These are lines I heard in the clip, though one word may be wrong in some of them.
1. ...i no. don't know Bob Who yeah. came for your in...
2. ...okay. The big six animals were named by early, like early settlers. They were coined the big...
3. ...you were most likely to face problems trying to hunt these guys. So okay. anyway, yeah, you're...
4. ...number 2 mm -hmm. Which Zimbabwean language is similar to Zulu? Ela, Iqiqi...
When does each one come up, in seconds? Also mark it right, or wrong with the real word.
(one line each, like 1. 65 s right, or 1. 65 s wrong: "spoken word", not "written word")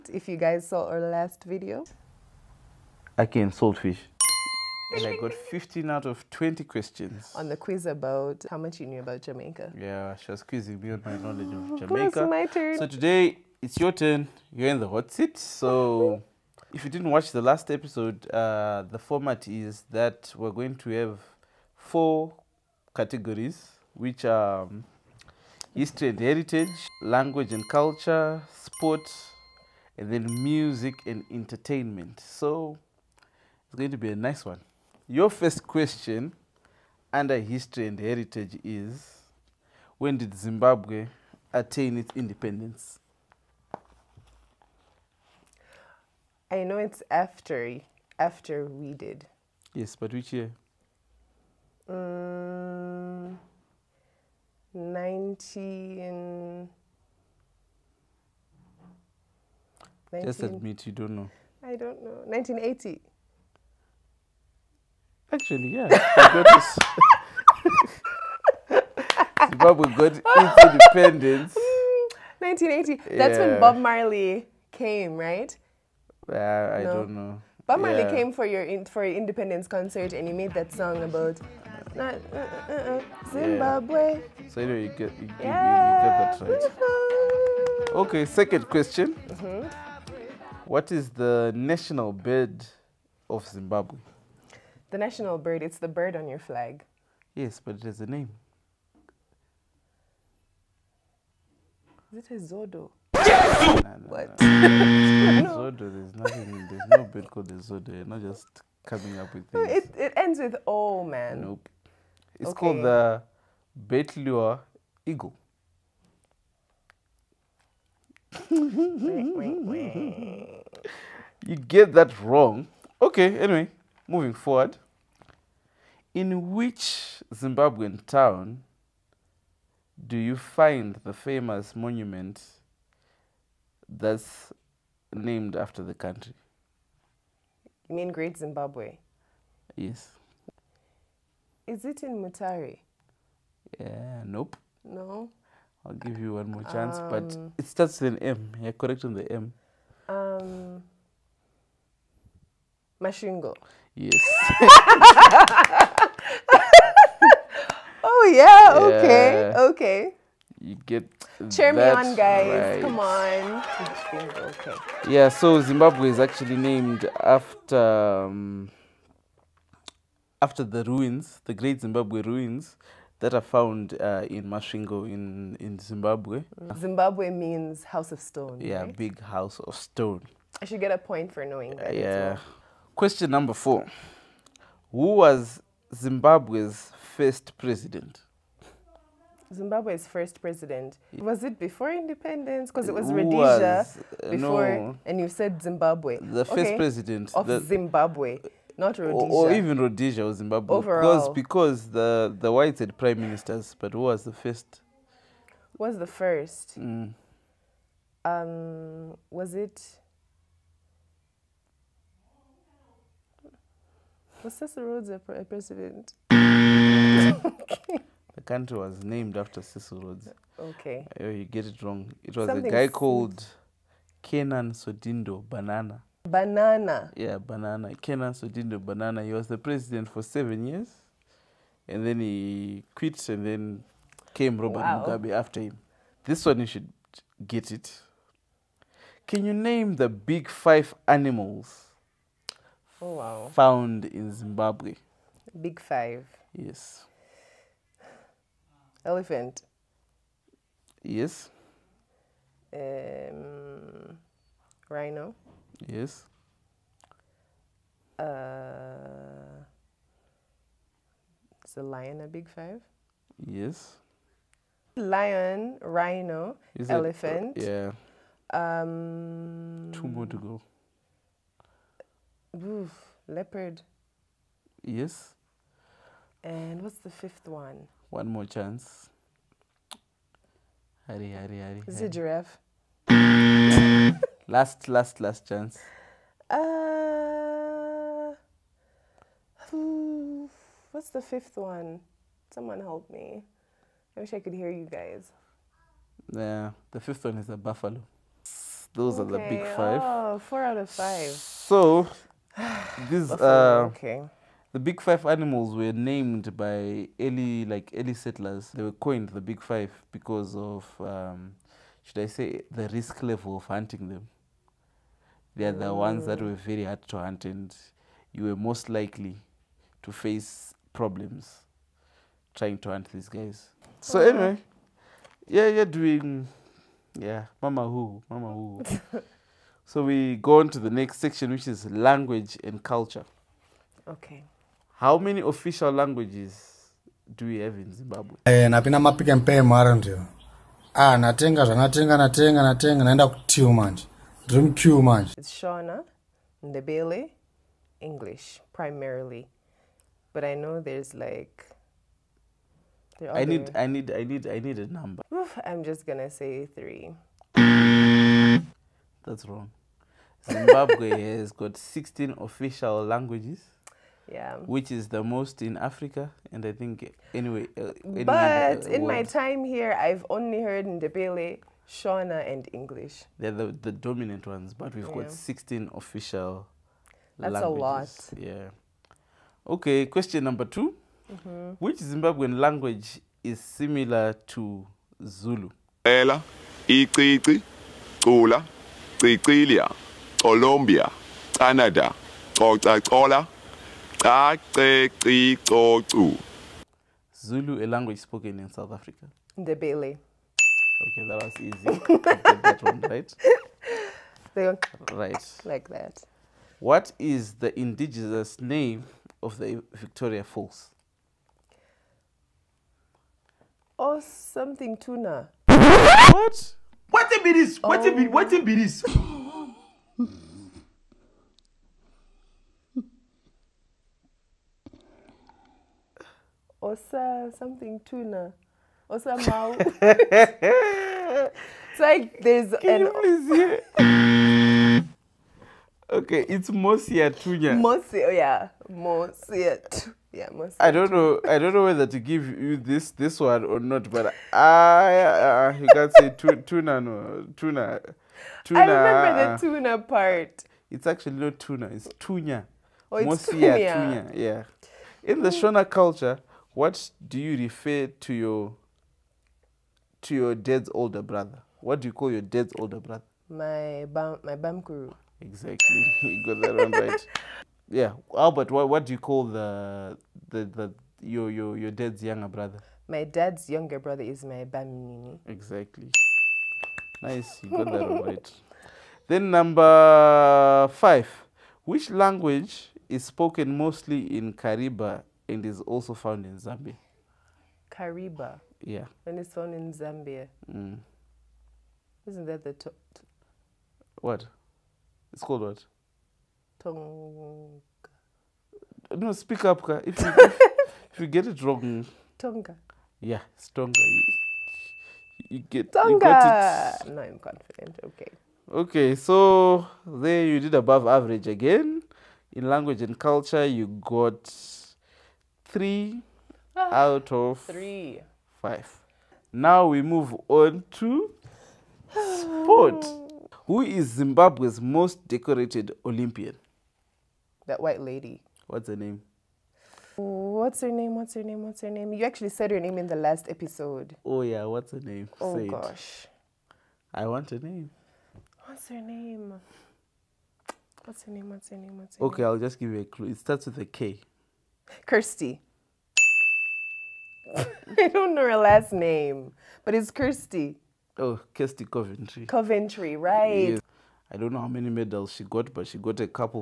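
1. 76 s wrong: "Marley", not "Who"
2. 303 s wrong: "five", not "six"
3. 318 s right
4. 380 s right.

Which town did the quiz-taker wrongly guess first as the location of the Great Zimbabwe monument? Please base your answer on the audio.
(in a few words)
Mutare.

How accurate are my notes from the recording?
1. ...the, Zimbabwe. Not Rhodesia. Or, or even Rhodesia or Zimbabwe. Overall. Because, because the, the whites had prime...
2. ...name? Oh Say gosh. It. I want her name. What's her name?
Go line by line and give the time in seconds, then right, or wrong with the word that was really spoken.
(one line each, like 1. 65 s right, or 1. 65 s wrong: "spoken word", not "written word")
1. 197 s right
2. 535 s right.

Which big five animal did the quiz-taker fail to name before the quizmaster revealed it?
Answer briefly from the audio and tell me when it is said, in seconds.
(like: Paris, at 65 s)
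Buffalo, at 296 s.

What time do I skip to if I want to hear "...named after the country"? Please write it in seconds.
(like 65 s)
135 s.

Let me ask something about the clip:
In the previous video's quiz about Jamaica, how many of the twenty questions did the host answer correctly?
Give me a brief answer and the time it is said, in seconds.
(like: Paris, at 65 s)
15, at 5 s.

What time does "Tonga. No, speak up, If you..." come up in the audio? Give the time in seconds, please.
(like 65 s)
496 s.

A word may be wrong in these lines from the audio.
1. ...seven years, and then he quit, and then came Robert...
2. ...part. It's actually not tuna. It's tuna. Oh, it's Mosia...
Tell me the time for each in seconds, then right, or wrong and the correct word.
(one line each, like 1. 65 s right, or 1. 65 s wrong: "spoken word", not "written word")
1. 230 s right
2. 449 s right.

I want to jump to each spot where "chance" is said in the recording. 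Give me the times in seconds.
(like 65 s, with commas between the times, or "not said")
146 s, 278 s, 285 s.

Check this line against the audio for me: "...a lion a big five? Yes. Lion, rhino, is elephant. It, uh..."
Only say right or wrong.
right.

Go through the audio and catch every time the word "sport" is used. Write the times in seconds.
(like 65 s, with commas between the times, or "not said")
28 s, 522 s.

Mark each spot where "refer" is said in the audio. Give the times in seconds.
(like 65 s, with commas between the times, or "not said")
457 s.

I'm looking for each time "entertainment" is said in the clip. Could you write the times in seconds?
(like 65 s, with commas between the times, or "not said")
31 s.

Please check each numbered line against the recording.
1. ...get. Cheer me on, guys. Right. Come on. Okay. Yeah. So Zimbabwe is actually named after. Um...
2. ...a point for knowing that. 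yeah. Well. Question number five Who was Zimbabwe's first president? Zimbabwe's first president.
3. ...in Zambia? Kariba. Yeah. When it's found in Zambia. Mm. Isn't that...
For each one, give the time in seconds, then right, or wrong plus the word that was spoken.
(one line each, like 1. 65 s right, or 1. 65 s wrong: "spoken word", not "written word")
1. 160 s right
2. 180 s wrong: "four", not "five"
3. 486 s right.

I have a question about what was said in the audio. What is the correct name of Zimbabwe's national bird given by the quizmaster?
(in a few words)
Bateleur eagle.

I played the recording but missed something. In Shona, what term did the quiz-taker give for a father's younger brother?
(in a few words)
Bamini.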